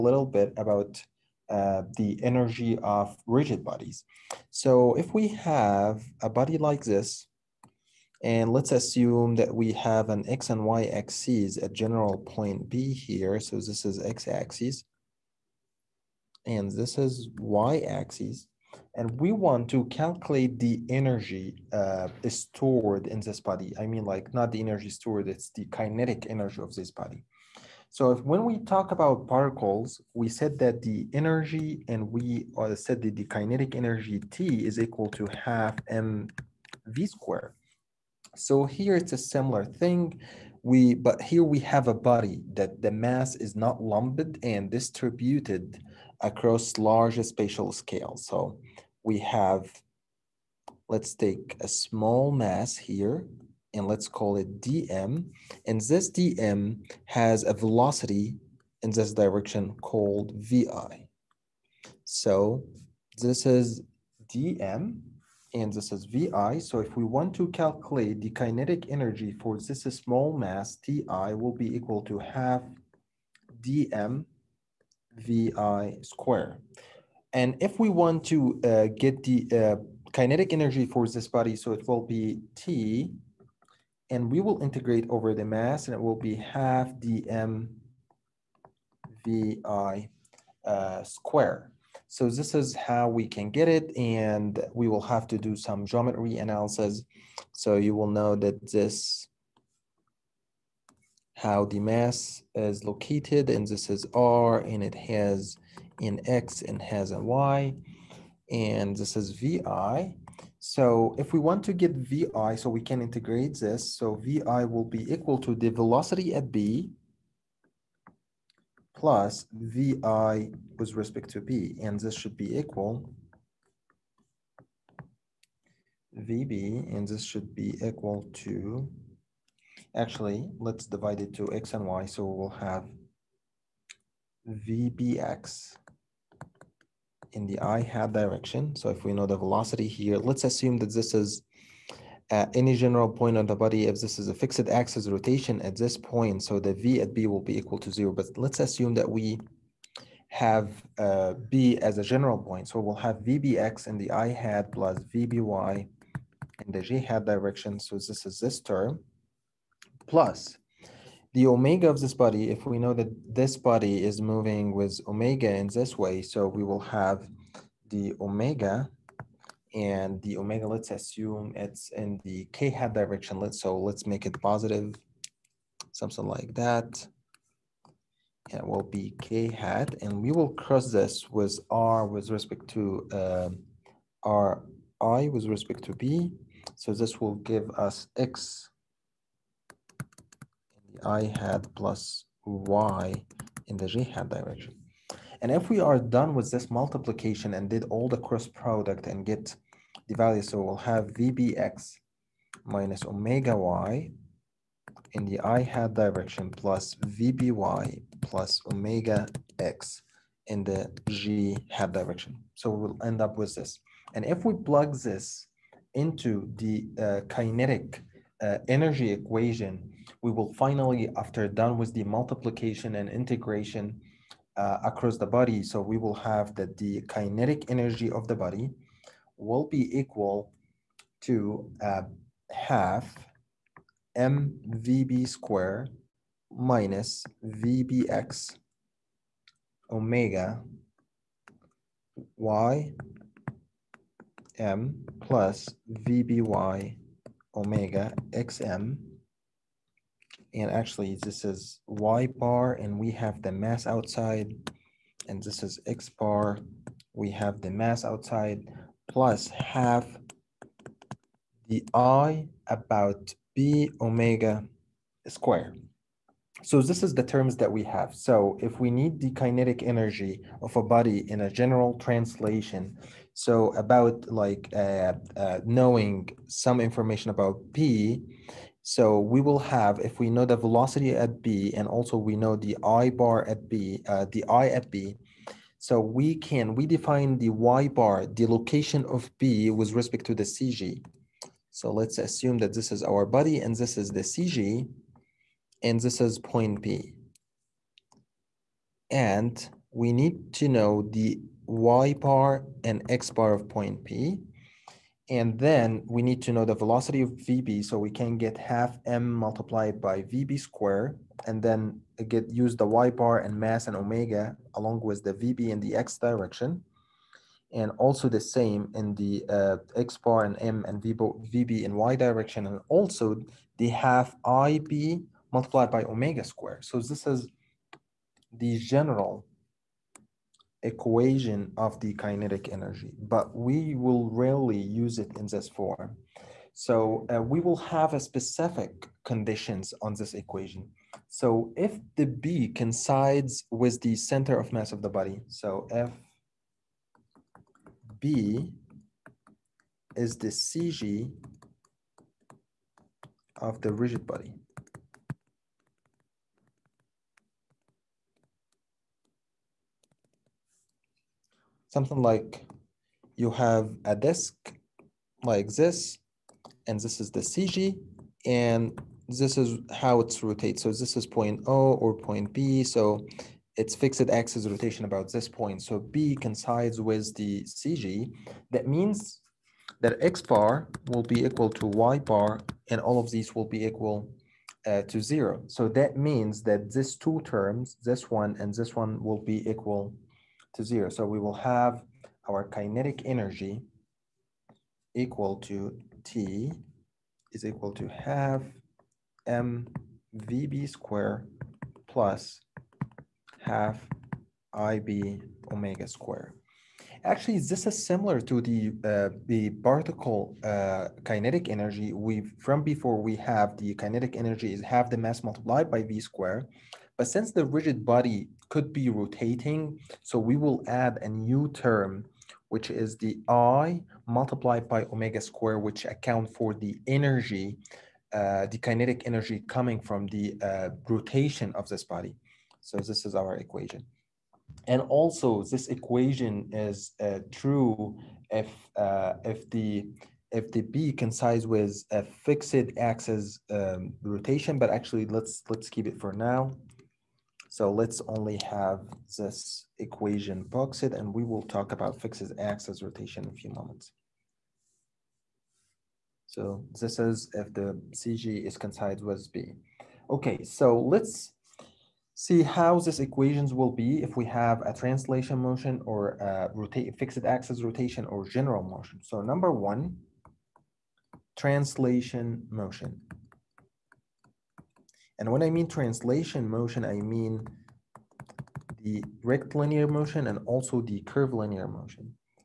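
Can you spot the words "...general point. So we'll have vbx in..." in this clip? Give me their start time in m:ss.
2:32.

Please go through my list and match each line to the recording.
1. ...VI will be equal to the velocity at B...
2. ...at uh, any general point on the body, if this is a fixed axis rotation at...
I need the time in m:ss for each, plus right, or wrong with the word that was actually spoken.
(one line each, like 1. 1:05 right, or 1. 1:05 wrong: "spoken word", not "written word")
1. 1:54 right
2. 2:22 right.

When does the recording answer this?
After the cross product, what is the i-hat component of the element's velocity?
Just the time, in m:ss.
3:21.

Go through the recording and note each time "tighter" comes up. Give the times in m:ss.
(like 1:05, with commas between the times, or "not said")
not said.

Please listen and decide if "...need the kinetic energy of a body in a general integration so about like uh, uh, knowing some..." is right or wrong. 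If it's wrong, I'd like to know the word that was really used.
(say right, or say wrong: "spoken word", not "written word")
wrong: "translation", not "integration".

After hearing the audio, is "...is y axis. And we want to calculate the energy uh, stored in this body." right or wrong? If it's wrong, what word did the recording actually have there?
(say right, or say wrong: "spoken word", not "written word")
right.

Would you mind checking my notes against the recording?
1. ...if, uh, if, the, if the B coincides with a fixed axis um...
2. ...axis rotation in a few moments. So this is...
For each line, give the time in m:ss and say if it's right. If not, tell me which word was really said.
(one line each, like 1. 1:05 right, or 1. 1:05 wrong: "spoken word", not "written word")
1. 7:18 right
2. 7:32 right.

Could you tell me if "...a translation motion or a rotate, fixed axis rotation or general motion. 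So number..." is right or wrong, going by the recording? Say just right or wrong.
right.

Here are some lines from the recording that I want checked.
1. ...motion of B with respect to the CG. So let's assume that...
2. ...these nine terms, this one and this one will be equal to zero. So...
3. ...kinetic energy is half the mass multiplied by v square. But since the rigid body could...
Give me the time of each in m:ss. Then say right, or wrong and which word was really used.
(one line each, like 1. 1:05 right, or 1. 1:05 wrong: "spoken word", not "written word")
1. 4:48 wrong: "location", not "motion"
2. 6:26 wrong: "two", not "nine"
3. 6:53 right.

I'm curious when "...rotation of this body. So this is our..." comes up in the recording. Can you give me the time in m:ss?
7:11.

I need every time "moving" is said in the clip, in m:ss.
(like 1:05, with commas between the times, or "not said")
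2:44.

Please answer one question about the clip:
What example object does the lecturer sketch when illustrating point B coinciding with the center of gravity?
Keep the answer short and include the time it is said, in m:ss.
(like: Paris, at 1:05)
A disk, at 6:04.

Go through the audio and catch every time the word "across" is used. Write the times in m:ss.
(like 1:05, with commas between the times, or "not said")
0:46, 3:44.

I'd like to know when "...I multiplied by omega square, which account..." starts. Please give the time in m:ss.
7:03.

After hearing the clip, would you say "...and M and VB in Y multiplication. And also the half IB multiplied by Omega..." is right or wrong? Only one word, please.
wrong.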